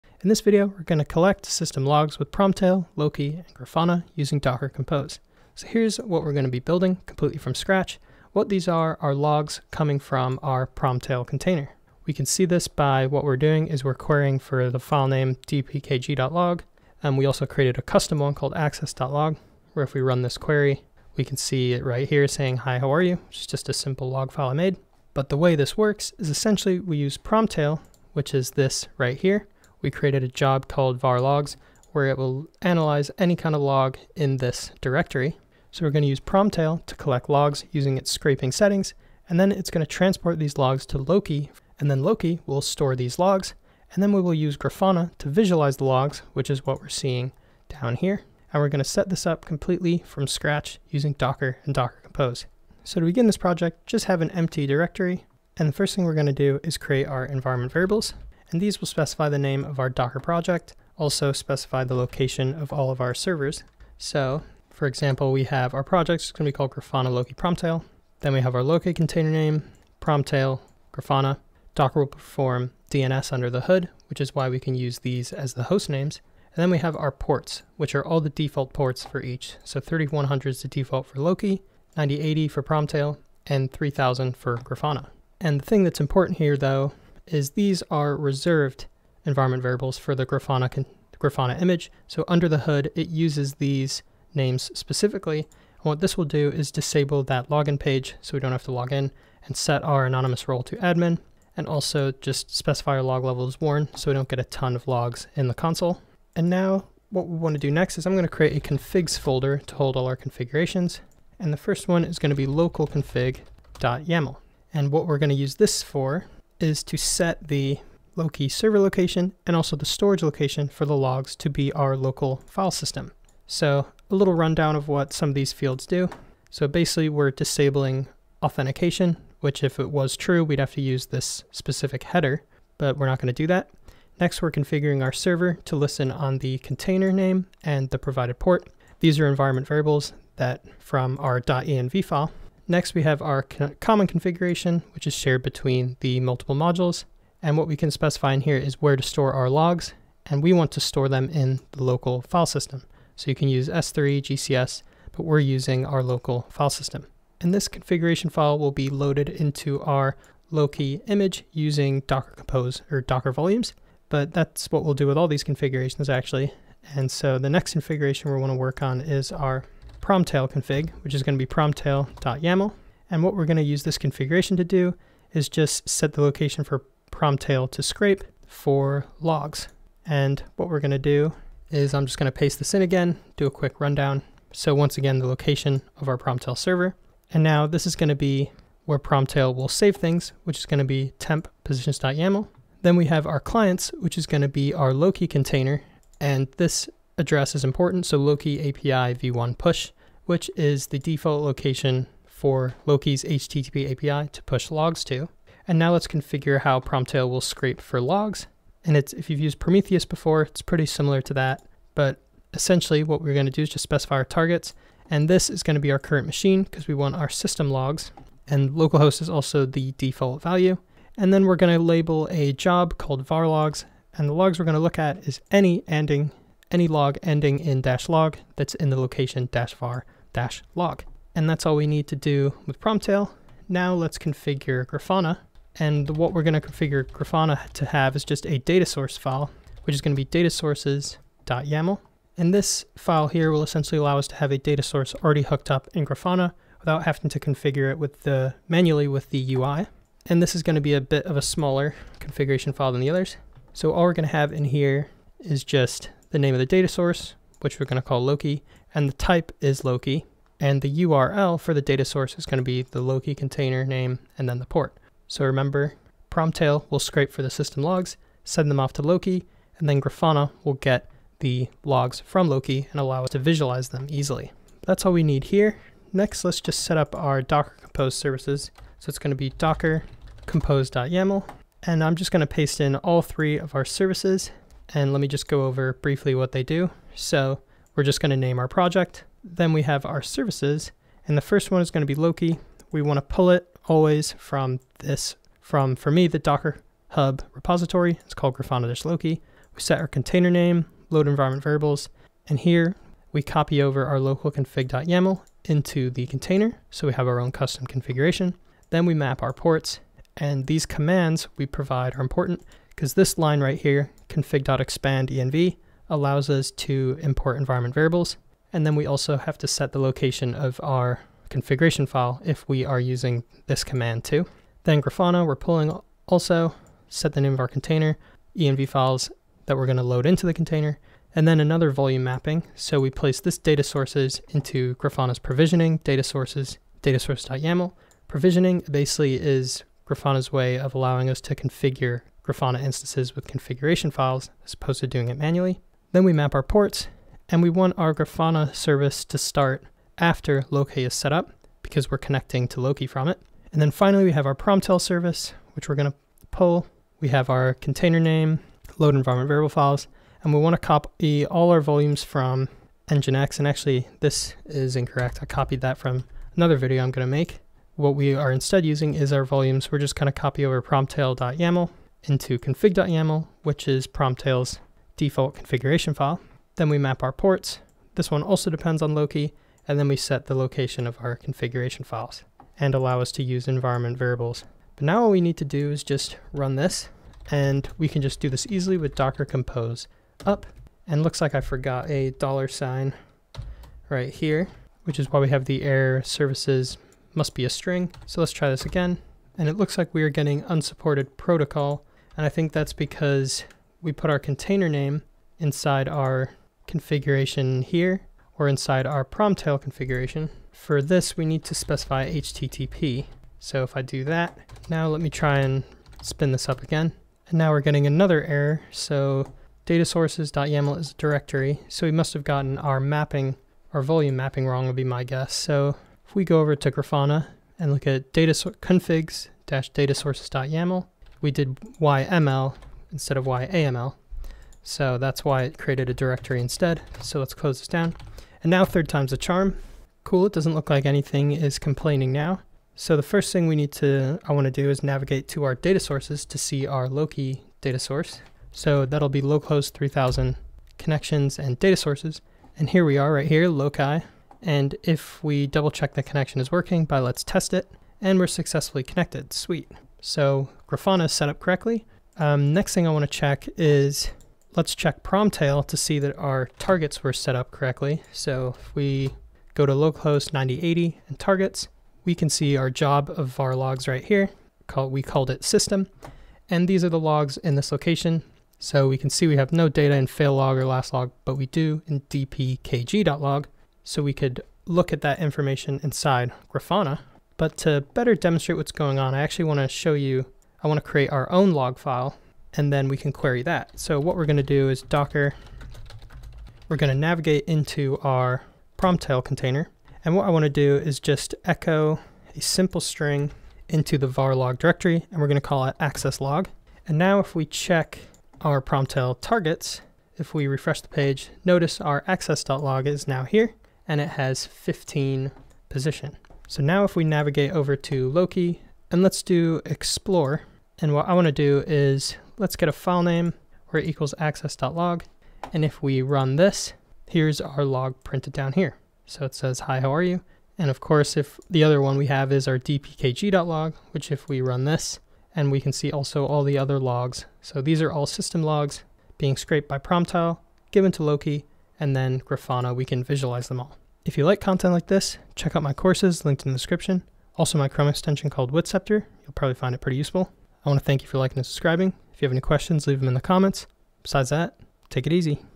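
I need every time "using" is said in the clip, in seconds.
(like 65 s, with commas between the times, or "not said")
4 s, 37 s, 50 s, 155 s, 161 s, 322 s, 368 s.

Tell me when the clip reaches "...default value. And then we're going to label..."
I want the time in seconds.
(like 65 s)
219 s.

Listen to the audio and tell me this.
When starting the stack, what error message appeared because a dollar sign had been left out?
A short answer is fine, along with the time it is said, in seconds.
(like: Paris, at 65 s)
services must be a string, at 396 s.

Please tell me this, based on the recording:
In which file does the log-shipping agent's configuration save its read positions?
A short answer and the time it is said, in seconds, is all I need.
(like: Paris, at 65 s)
temp positions.yaml, at 191 s.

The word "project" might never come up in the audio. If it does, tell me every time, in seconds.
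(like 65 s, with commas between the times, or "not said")
53 s, 60 s, 65 s, 288 s.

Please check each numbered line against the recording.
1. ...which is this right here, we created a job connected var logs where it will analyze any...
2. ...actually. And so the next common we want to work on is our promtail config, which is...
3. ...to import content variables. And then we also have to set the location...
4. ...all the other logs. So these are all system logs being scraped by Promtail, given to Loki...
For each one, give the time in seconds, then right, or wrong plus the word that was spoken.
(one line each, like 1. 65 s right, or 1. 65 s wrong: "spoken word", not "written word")
1. 28 s wrong: "called", not "connected"
2. 166 s wrong: "configuration", not "common"
3. 316 s wrong: "environment", not "content"
4. 536 s right.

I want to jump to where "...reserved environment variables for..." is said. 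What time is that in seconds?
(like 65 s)
88 s.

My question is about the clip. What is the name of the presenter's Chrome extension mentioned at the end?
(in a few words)
WittCepter.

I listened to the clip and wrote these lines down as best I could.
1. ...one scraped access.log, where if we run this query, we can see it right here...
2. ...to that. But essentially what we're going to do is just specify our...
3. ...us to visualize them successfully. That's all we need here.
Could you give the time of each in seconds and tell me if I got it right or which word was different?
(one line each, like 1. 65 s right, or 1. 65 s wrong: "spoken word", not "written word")
1. 18 s wrong: "called", not "scraped"
2. 211 s right
3. 273 s wrong: "easily", not "successfully".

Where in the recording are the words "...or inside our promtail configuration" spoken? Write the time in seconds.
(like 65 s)
408 s.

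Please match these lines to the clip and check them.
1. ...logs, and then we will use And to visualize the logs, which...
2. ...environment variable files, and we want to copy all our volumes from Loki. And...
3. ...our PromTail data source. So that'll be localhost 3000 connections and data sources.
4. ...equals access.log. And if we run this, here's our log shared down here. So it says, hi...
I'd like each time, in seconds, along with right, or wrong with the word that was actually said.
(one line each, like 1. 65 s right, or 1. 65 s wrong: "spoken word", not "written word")
1. 43 s wrong: "Grafana", not "And"
2. 359 s wrong: "Nginx", not "Loki"
3. 446 s wrong: "Loki", not "PromTail"
4. 524 s wrong: "printed", not "shared".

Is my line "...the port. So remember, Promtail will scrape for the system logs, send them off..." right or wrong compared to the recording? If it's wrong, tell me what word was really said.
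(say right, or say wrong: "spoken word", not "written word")
right.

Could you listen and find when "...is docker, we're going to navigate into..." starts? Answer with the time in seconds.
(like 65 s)
494 s.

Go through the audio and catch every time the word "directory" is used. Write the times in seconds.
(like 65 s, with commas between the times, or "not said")
34 s, 54 s, 421 s, 436 s, 504 s.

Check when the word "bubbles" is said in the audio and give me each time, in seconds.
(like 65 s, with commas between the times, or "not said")
not said.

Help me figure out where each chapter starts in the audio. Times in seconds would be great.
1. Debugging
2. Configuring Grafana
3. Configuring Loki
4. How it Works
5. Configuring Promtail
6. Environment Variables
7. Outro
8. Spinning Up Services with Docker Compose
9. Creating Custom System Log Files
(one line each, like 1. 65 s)
1. 384 s
2. 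233 s
3. 106 s
4. 35 s
5. 167 s
6. 52 s
7. 544 s
8. 274 s
9. 438 s.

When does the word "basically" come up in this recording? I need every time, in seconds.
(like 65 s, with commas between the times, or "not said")
126 s, 338 s.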